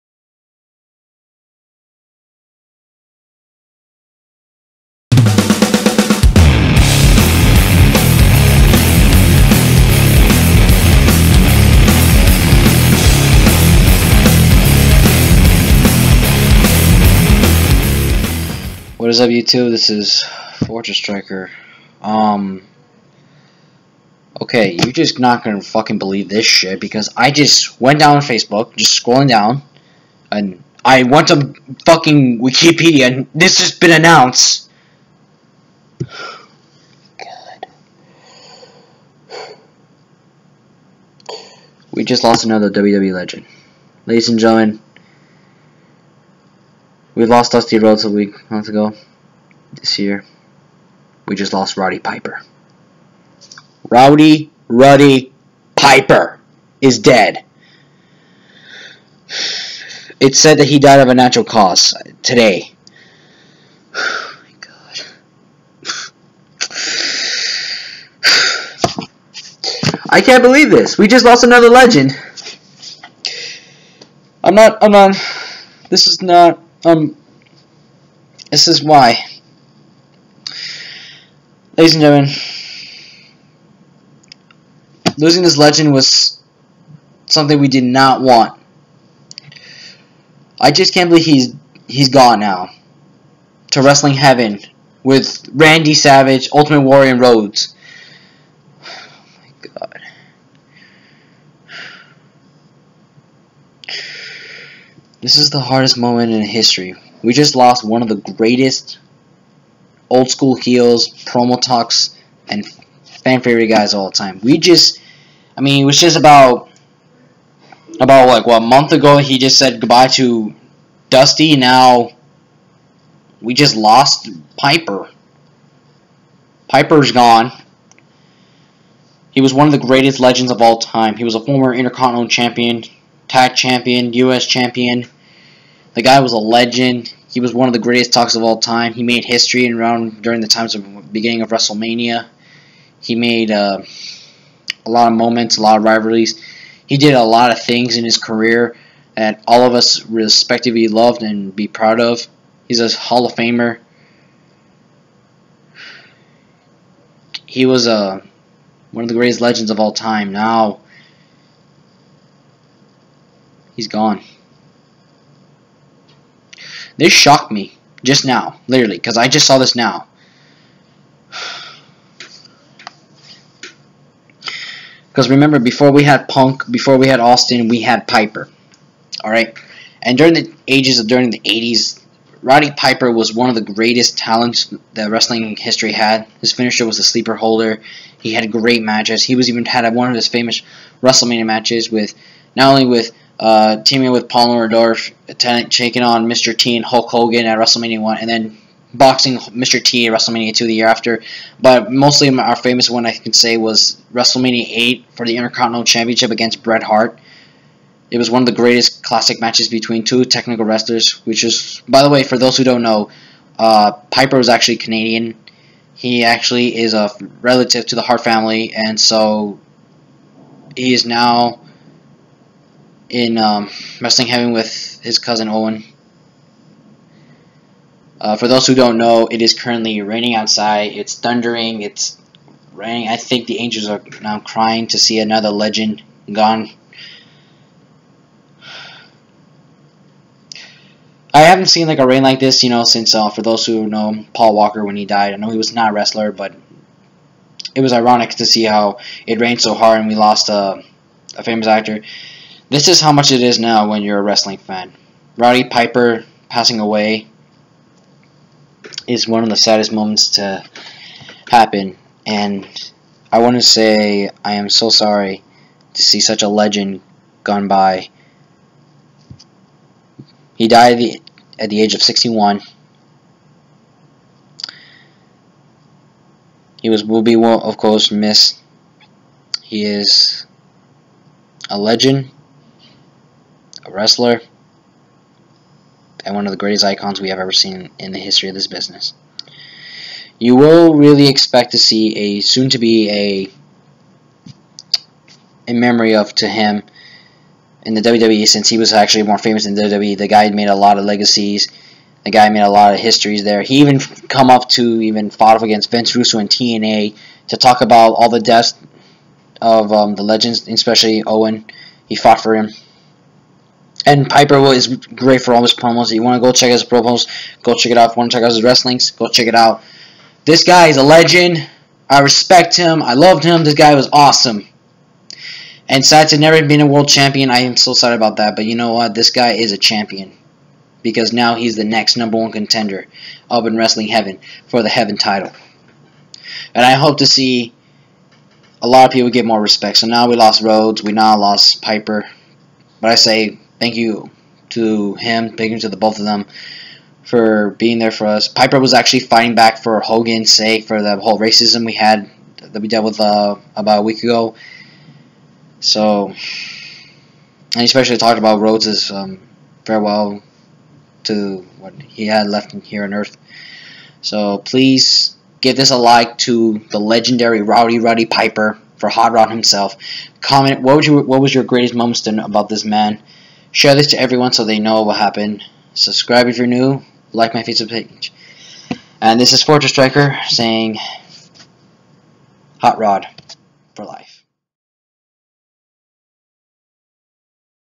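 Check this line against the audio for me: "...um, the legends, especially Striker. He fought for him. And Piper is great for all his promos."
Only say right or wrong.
wrong.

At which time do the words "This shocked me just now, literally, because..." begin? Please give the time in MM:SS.
02:46.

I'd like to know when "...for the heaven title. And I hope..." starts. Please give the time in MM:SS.
05:34.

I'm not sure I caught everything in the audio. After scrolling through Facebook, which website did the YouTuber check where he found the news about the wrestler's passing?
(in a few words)
Wikipedia.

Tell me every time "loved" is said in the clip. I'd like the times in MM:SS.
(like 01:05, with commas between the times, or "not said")
02:30, 05:23.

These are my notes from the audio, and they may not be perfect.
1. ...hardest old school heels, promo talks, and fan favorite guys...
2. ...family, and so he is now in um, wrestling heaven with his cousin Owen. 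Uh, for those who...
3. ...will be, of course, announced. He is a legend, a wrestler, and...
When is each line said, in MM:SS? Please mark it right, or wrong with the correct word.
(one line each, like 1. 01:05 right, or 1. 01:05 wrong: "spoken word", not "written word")
1. 01:48 wrong: "greatest", not "hardest"
2. 03:38 right
3. 04:37 wrong: "missed", not "announced".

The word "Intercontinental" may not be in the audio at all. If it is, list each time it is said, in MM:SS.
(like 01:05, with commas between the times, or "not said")
02:11, 03:25.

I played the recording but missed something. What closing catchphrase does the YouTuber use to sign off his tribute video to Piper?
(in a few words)
Hot Rod for life.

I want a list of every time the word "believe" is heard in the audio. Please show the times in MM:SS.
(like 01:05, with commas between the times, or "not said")
00:25, 01:10, 01:31.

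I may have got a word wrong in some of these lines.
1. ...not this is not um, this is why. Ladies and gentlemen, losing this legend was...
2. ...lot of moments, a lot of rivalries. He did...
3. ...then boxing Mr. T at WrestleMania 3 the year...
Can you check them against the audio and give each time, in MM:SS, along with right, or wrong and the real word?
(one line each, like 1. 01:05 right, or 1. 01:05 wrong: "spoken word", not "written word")
1. 01:14 right
2. 02:24 right
3. 03:18 wrong: "2", not "3".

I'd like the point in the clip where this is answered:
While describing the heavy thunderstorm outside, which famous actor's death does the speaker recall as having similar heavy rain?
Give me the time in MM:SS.
04:04.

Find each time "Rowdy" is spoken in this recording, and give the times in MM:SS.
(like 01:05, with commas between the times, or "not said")
00:53, 06:07.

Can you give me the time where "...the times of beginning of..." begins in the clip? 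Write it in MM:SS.
02:20.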